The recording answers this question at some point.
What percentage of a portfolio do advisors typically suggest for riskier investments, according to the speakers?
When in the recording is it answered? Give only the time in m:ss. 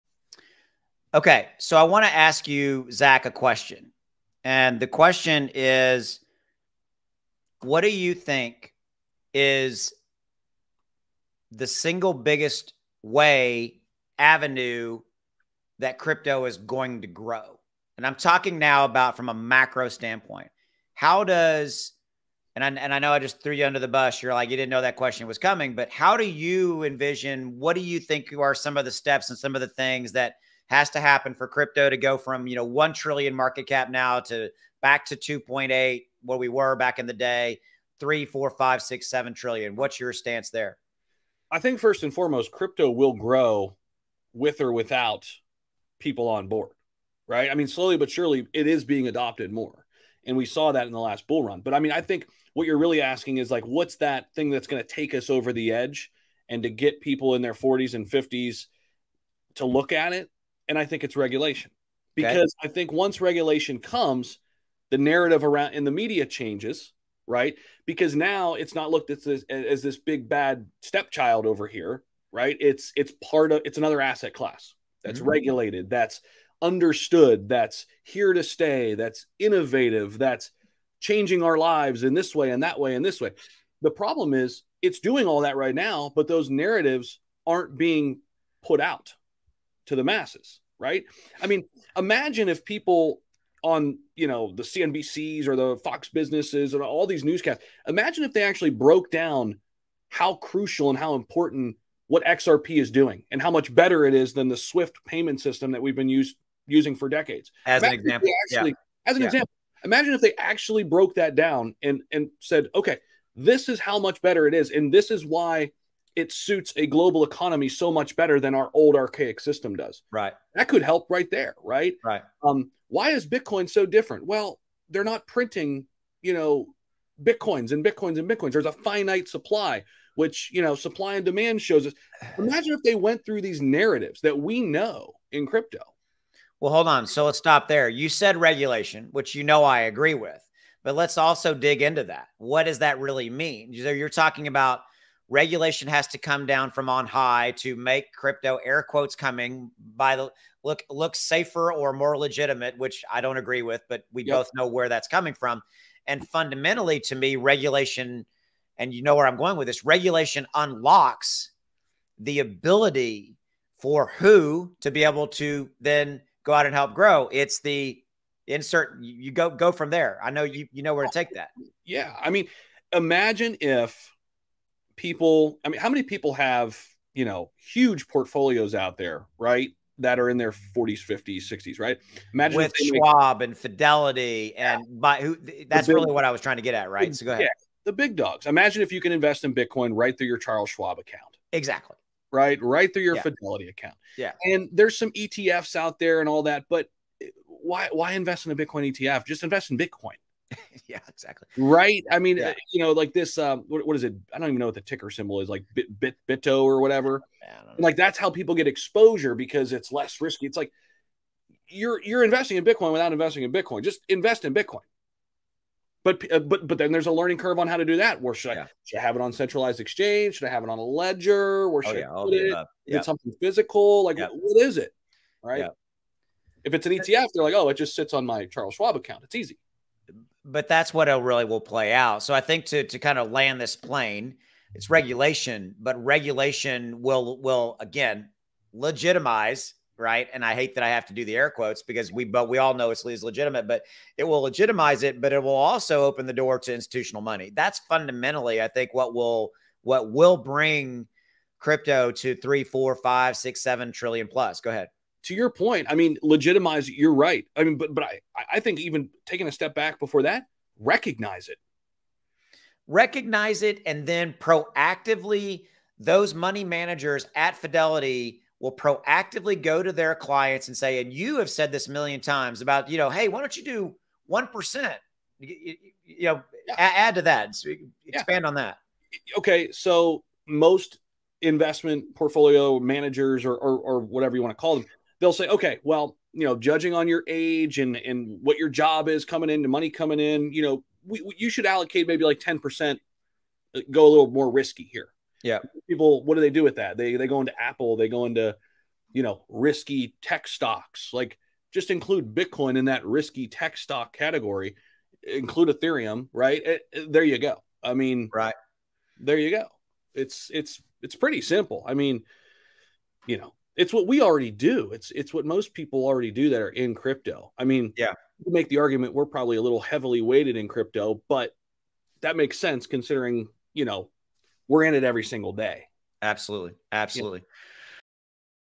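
4:52.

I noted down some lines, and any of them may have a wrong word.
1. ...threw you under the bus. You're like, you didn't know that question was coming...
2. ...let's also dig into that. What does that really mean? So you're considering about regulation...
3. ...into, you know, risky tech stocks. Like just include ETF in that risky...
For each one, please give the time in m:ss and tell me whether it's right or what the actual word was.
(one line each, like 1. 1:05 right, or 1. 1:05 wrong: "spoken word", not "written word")
1. 0:23 right
2. 2:20 wrong: "talking", not "considering"
3. 4:58 wrong: "Bitcoin", not "ETF".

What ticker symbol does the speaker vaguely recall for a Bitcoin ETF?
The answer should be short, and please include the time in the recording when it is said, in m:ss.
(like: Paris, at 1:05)
BITO, at 3:26.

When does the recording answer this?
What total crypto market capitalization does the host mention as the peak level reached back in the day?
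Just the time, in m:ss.
0:35.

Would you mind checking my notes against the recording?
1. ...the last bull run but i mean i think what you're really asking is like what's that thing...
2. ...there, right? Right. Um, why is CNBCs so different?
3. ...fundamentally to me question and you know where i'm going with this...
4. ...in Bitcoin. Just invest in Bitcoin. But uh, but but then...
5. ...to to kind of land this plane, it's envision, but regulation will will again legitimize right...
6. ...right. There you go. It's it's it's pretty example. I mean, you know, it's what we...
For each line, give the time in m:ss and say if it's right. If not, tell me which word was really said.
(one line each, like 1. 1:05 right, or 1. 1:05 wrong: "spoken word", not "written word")
1. 0:50 right
2. 2:01 wrong: "Bitcoin", not "CNBCs"
3. 2:36 wrong: "regulation", not "question"
4. 3:33 right
5. 3:52 wrong: "regulation", not "envision"
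6. 5:08 wrong: "simple", not "example".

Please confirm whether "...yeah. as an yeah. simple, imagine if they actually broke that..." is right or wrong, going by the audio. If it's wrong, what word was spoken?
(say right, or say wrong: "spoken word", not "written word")
wrong: "example", not "simple".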